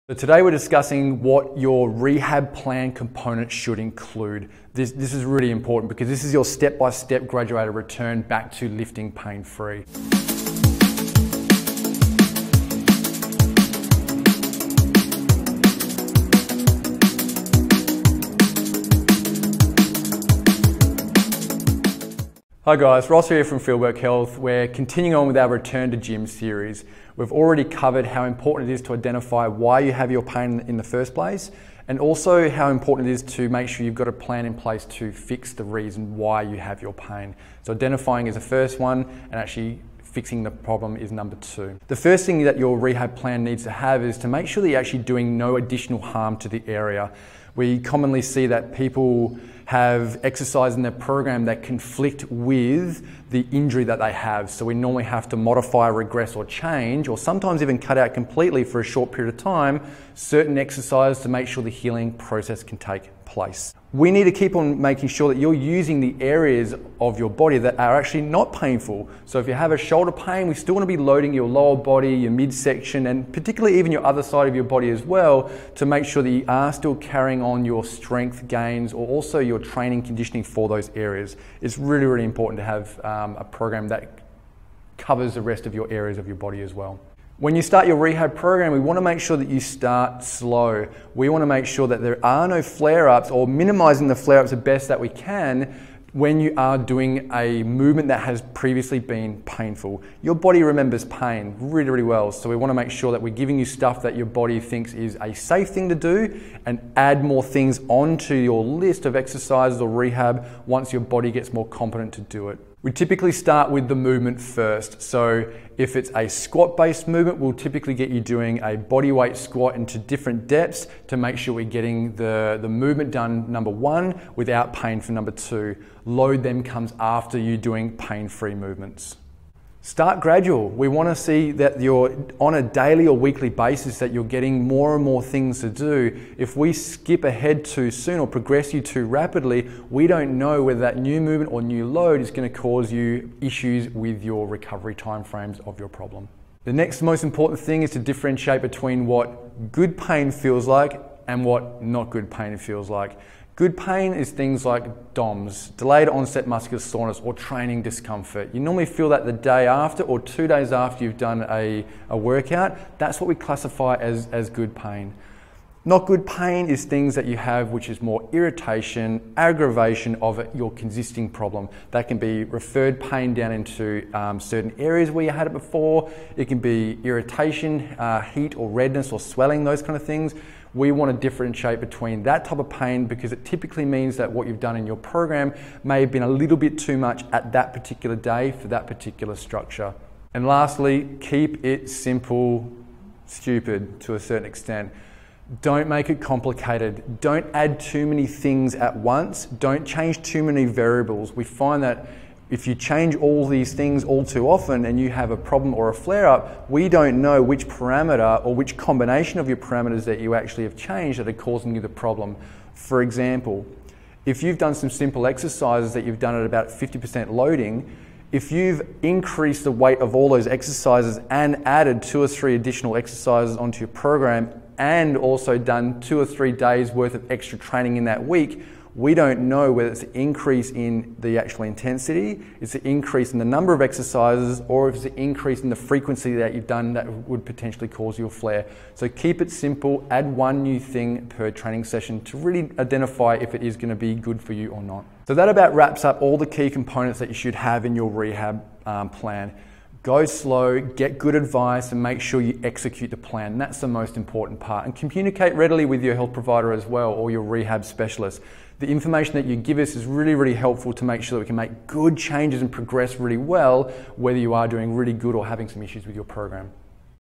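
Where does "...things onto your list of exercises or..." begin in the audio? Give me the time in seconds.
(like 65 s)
107 s.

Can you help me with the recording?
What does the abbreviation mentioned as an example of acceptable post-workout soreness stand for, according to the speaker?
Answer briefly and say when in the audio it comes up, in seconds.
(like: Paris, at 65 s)
delayed onset muscular soreness, at 155 s.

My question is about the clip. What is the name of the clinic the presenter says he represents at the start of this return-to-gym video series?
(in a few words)
Fieldwork Health.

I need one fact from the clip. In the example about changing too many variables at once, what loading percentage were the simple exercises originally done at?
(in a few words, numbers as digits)
50%.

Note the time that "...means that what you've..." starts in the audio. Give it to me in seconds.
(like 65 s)
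183 s.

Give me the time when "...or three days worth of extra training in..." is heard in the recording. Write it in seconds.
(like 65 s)
226 s.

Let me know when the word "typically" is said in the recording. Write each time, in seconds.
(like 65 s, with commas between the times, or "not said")
112 s, 117 s, 183 s.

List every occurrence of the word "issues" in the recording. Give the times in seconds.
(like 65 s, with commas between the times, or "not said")
143 s, 265 s.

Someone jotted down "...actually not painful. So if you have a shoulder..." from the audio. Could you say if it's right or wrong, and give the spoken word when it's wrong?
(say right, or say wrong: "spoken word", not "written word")
right.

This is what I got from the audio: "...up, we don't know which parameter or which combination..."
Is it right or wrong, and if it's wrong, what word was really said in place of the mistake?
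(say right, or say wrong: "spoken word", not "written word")
right.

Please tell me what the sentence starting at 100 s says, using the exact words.
Your body remembers pain really, really well.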